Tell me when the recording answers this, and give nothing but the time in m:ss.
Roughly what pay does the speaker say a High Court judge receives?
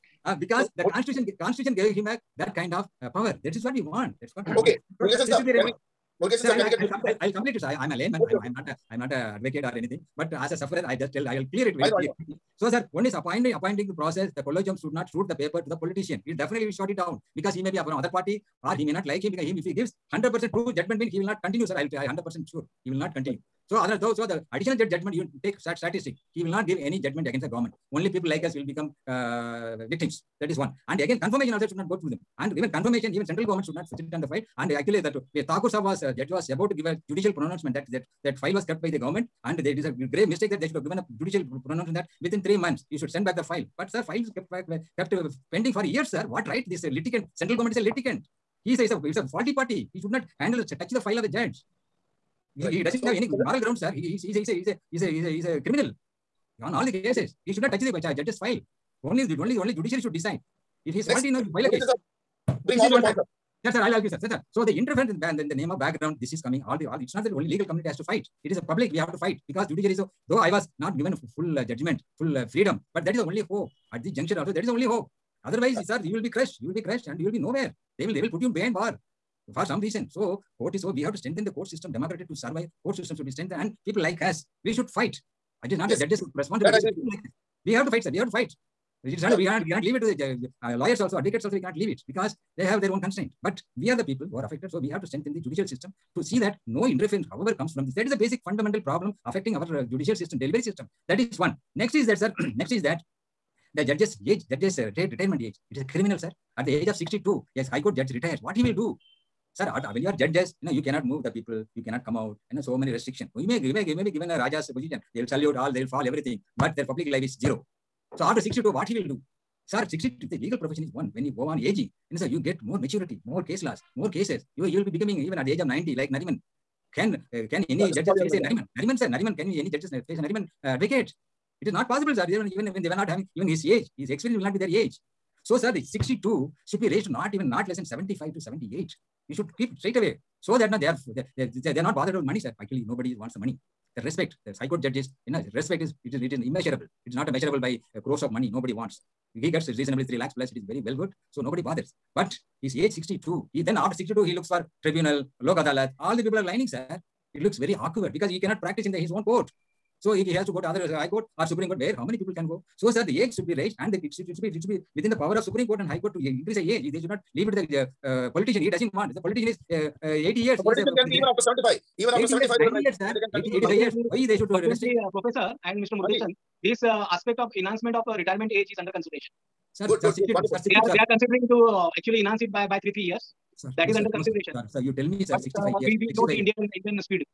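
2:30.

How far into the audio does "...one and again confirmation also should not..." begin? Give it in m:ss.
0:30.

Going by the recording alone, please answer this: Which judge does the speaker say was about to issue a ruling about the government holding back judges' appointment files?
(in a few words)
Thakur.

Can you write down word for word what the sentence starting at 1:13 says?
At this juncture also, that is the only hope.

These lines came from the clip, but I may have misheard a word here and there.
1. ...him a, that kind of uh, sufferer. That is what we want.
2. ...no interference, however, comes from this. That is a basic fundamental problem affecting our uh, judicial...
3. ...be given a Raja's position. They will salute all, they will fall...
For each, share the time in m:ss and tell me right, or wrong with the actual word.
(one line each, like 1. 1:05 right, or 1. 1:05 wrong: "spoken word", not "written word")
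1. 0:01 wrong: "power", not "sufferer"
2. 1:36 right
3. 1:54 right.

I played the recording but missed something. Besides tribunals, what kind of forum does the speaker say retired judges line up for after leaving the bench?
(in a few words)
Lok adalat.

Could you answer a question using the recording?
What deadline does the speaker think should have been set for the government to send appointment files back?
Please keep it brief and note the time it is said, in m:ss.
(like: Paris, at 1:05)
3 months, at 0:42.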